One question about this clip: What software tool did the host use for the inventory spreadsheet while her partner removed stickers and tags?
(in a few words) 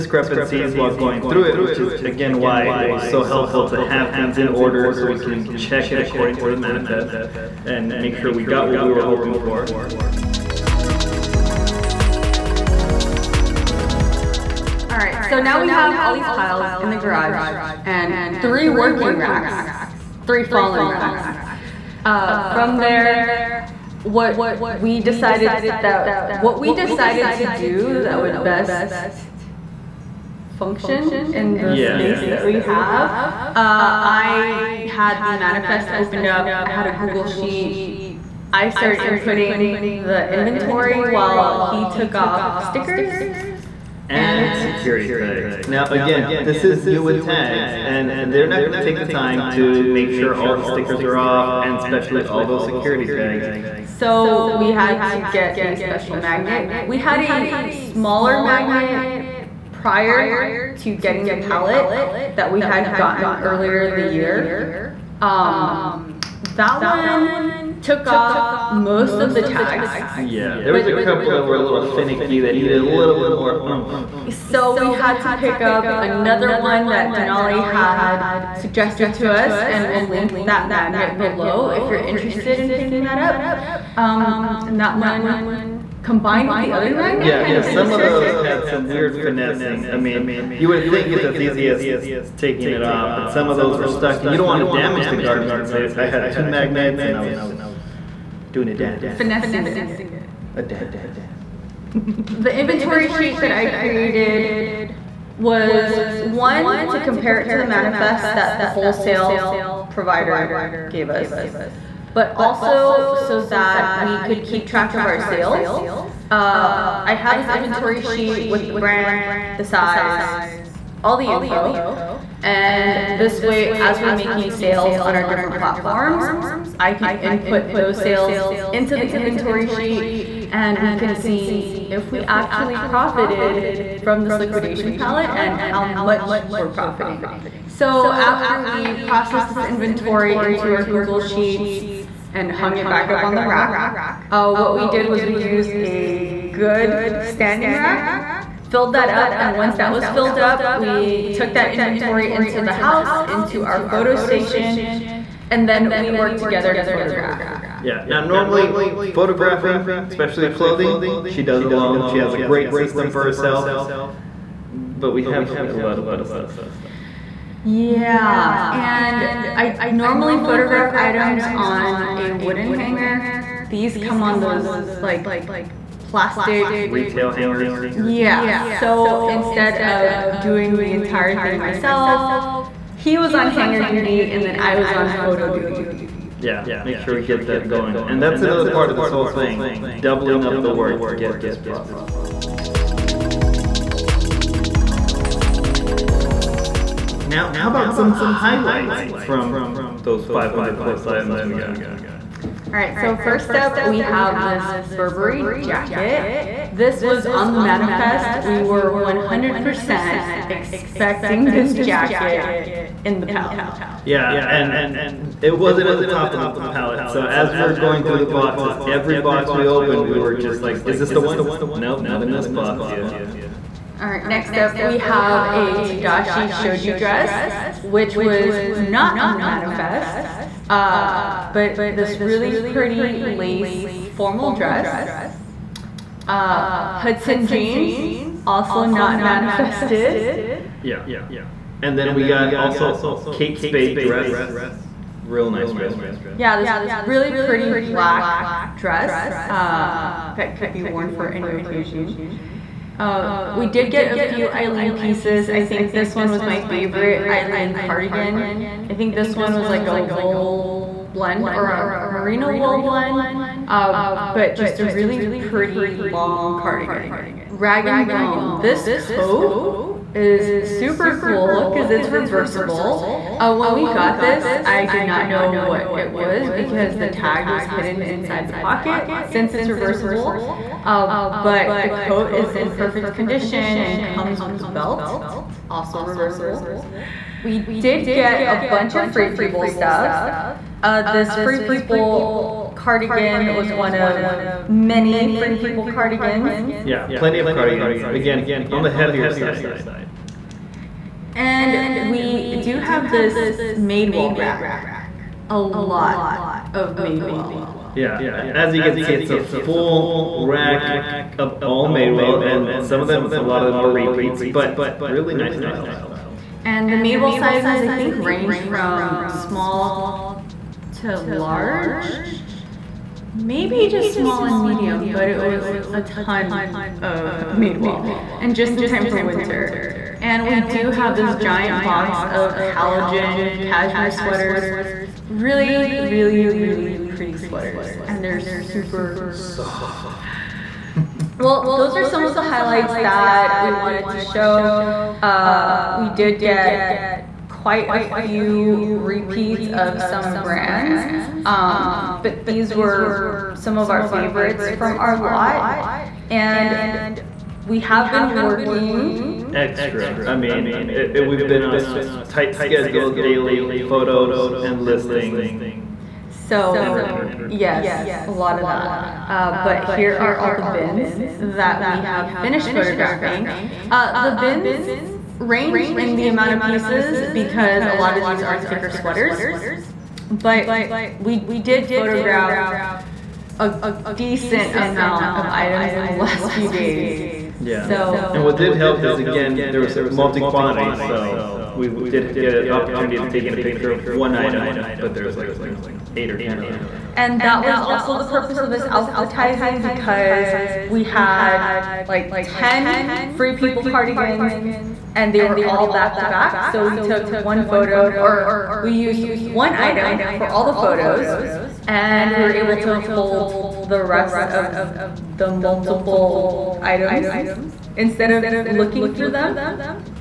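Google Sheet.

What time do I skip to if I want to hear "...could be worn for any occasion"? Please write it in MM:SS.
04:10.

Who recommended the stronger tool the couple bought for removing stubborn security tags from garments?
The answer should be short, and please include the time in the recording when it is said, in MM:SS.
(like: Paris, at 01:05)
Denali, at 01:17.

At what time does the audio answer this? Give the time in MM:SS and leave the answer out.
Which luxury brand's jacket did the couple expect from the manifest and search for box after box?
03:24.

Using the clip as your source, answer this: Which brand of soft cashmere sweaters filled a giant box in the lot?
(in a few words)
Halogen.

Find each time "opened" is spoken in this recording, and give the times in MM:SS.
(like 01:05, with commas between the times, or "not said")
00:35, 03:39.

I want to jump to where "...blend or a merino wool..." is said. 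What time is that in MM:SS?
04:21.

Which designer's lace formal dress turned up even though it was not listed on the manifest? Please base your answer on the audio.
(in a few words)
Tadashi Shoji.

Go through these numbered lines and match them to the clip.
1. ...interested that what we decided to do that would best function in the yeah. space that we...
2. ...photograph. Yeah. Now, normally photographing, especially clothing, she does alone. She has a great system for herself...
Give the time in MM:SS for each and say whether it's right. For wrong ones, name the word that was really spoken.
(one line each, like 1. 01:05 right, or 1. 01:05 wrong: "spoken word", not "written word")
1. 00:24 wrong: "decided", not "interested"
2. 02:36 right.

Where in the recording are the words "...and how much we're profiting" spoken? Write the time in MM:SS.
02:15.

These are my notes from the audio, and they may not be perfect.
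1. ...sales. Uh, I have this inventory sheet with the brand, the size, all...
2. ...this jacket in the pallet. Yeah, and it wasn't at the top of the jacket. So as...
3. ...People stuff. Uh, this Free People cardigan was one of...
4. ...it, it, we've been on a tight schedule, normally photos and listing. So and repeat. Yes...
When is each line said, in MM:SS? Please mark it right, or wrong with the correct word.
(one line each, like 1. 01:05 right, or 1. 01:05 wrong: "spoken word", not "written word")
1. 01:55 right
2. 03:31 wrong: "pallet", not "jacket"
3. 04:49 right
4. 06:00 wrong: "daily", not "normally".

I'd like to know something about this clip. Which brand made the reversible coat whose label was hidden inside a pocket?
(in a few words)
Rag and Bone.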